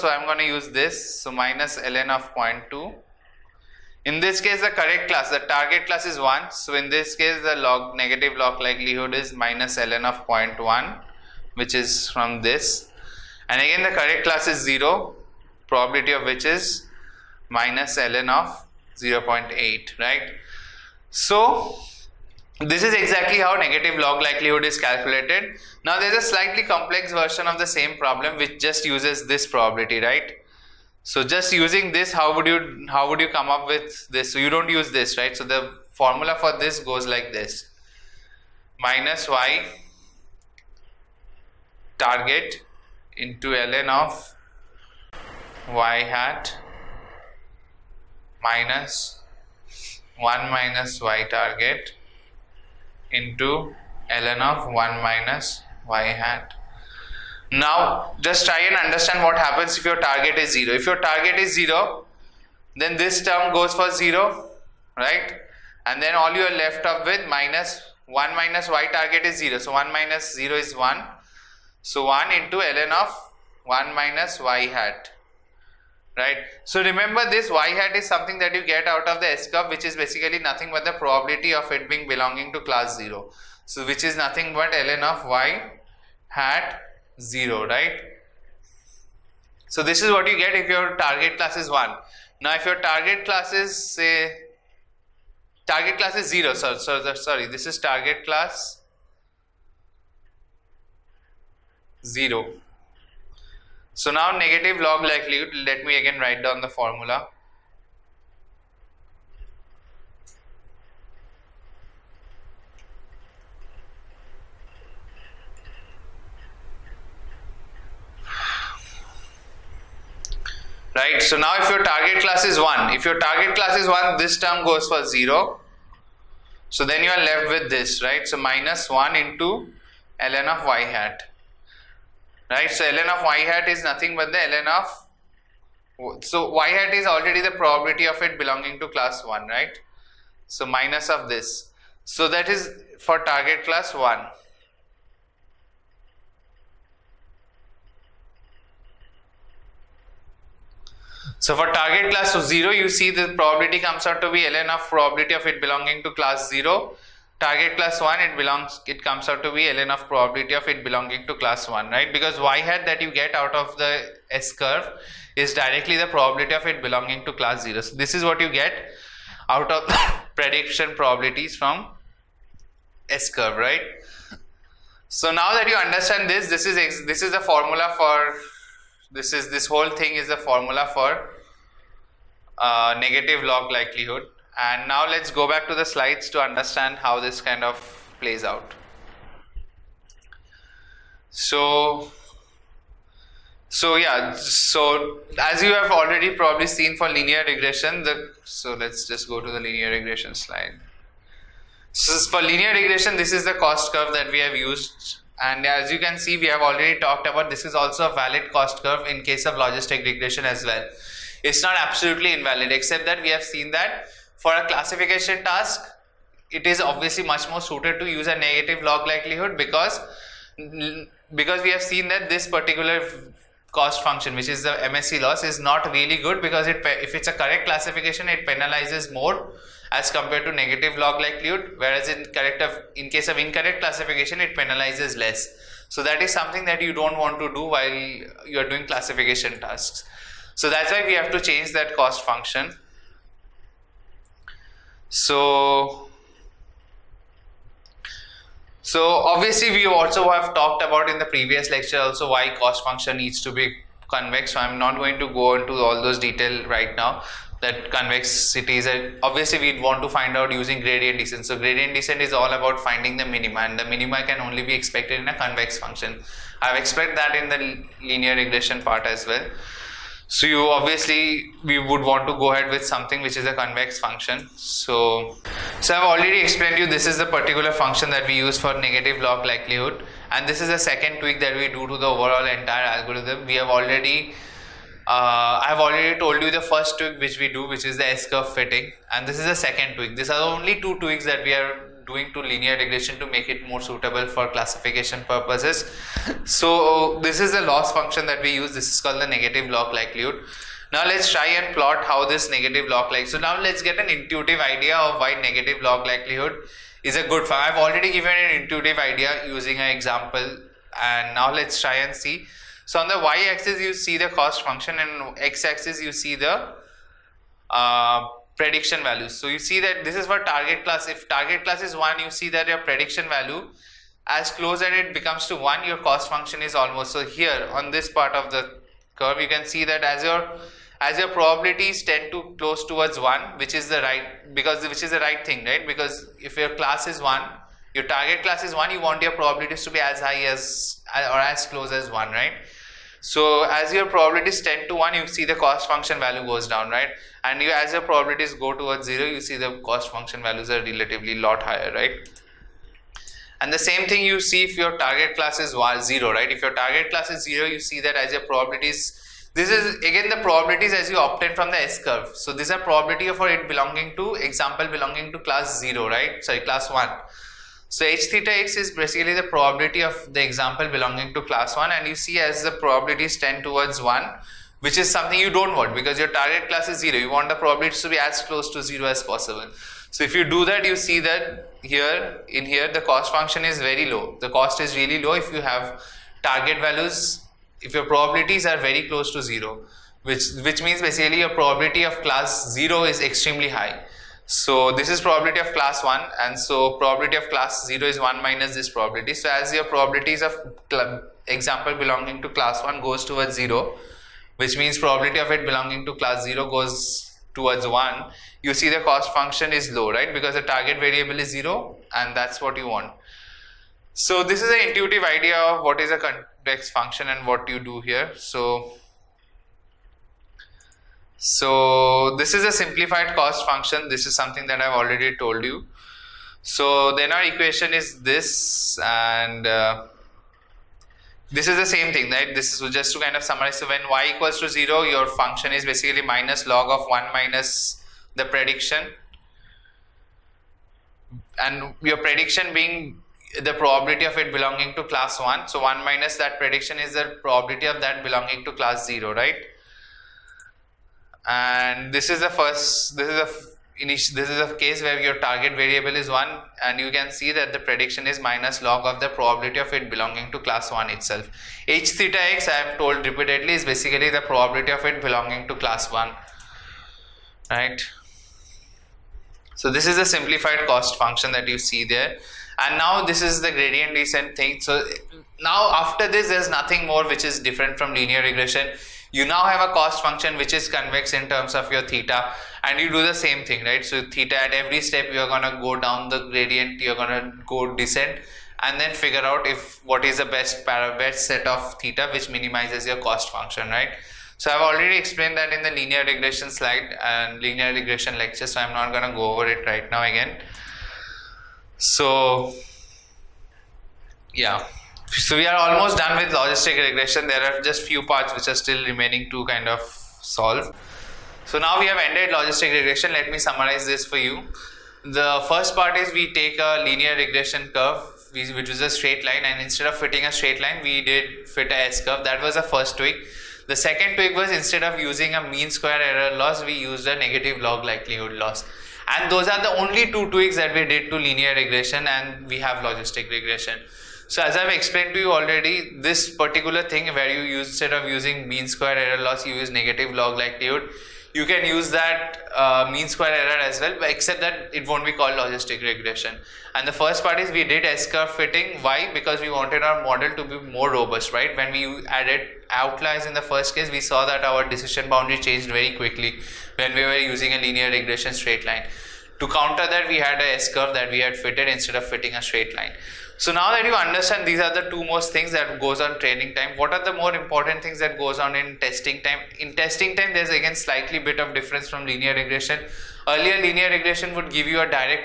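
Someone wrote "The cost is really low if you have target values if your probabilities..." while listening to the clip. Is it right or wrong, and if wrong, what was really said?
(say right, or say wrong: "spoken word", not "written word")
right.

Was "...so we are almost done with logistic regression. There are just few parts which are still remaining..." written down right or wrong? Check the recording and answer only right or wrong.
right.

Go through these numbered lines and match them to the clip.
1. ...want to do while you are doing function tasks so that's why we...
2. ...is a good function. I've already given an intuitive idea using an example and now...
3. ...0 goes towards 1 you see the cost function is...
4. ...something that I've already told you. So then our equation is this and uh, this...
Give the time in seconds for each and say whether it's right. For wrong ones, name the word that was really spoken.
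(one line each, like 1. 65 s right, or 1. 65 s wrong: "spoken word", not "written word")
1. 237 s wrong: "classification", not "function"
2. 307 s right
3. 406 s right
4. 424 s right.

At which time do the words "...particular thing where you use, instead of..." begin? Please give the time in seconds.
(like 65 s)
536 s.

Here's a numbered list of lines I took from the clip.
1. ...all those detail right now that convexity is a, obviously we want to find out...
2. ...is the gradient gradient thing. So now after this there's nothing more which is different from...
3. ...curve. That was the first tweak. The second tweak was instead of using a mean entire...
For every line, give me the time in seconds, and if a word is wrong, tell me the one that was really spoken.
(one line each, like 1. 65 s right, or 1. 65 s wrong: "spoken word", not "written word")
1. 255 s right
2. 473 s wrong: "descent", not "gradient"
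3. 522 s wrong: "square", not "entire".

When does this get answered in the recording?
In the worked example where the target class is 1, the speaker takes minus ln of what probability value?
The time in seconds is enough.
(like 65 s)
9 s.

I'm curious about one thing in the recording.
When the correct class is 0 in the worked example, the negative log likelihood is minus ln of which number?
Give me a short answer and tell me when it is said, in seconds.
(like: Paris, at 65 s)
0.8, at 17 s.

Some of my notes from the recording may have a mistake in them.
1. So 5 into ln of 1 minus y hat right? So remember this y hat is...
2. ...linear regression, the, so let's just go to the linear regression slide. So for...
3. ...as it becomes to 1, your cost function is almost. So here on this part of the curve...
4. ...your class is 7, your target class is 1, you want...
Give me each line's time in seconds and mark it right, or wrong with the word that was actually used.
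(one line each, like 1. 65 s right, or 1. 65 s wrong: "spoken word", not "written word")
1. 71 s wrong: "1", not "5"
2. 197 s right
3. 324 s right
4. 336 s wrong: "1", not "7".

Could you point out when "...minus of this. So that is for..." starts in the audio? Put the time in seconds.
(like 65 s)
140 s.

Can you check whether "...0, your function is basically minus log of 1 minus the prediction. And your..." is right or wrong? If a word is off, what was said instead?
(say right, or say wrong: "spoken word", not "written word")
right.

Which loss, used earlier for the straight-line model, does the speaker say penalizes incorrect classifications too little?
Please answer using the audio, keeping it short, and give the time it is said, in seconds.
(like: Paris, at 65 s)
MSE loss, at 224 s.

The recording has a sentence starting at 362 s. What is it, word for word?
So these are probability for it belonging to example belonging to class 0, right?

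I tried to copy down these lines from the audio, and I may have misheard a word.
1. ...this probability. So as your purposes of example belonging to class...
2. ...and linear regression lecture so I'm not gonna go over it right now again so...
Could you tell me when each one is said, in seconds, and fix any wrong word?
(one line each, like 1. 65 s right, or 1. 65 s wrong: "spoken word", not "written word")
1. 398 s wrong: "probabilities", not "purposes"
2. 497 s right.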